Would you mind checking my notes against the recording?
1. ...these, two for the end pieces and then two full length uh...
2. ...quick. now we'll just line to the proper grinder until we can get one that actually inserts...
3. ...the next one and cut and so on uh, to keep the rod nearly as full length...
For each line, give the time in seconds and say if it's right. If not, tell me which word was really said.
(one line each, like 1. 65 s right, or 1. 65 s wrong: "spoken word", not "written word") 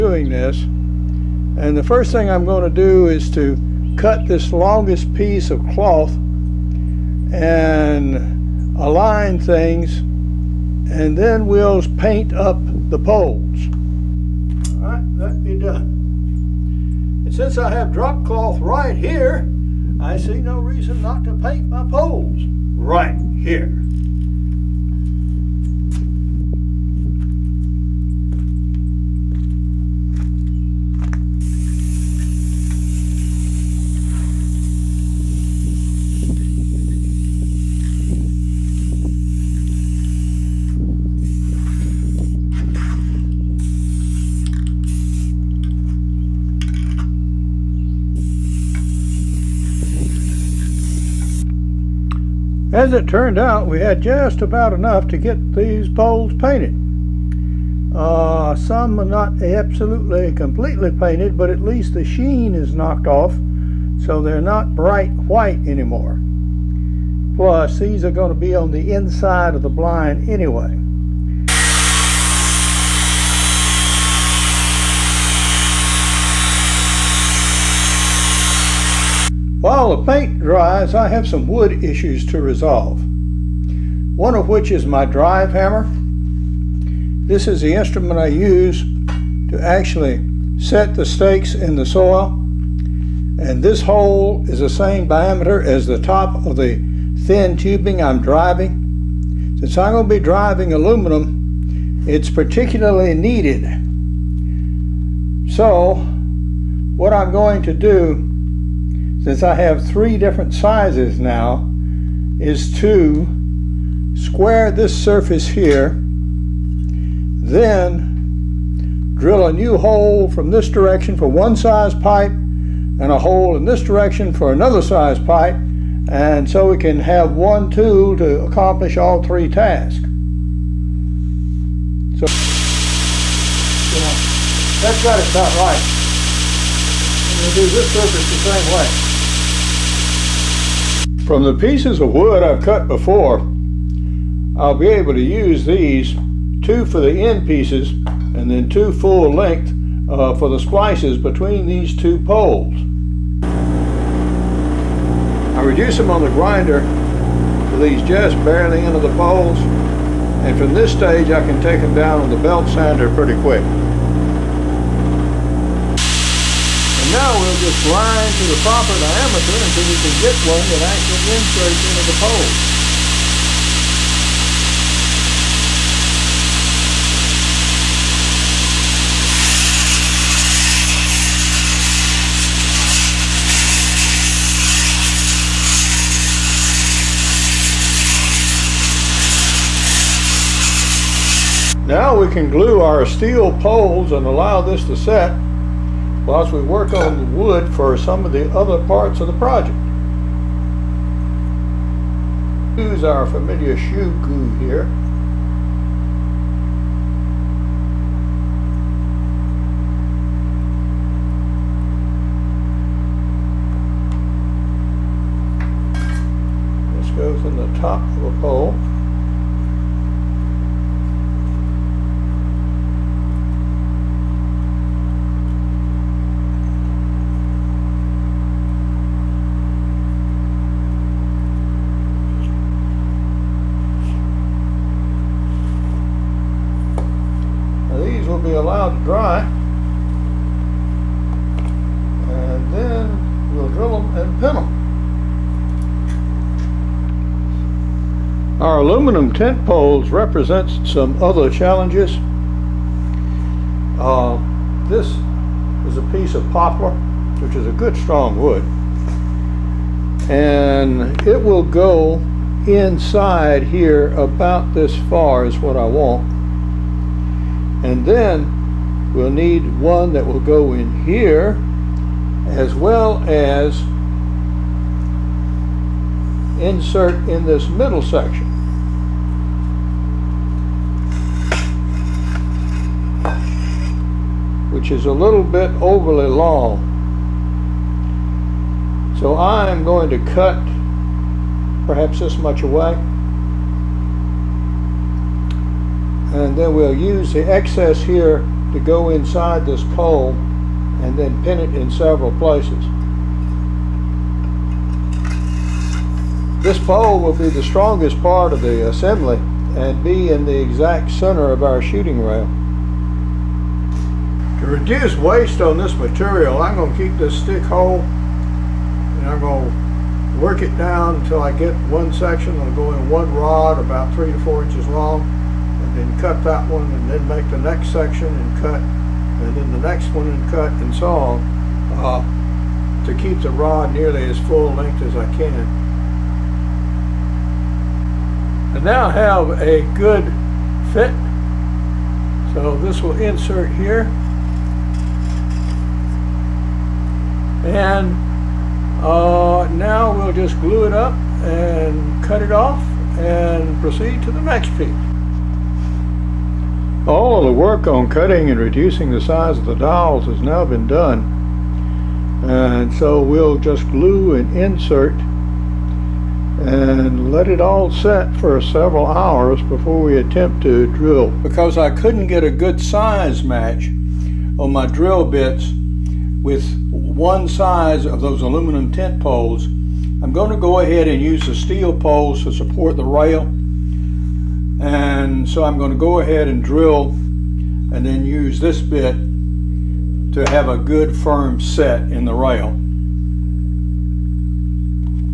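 1. 145 s right
2. 163 s wrong: "diameter", not "grinder"
3. 329 s right.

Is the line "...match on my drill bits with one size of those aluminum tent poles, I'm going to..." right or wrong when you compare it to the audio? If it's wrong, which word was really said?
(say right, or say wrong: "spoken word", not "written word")
right.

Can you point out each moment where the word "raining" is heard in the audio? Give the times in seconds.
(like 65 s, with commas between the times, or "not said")
not said.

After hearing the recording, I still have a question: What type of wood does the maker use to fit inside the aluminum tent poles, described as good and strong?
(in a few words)
poplar.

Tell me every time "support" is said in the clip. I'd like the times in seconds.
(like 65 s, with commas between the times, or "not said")
382 s.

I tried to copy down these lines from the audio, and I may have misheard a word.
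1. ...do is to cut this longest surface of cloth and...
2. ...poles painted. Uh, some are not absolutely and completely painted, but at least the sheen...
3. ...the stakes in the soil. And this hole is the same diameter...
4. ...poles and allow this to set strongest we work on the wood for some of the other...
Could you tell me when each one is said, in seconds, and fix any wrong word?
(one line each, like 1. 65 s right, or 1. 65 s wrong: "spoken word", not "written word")
1. 2 s wrong: "piece", not "surface"
2. 55 s right
3. 90 s right
4. 193 s wrong: "whilst", not "strongest".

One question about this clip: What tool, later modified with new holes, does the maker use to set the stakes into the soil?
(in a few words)
drive hammer.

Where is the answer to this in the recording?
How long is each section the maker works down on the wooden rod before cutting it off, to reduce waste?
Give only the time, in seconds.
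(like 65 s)
324 s.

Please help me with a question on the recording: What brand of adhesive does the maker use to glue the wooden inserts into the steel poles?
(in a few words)
Shoe Goo.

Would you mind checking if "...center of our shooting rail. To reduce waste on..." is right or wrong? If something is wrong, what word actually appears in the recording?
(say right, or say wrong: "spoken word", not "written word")
right.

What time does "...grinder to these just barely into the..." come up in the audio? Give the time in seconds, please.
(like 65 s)
156 s.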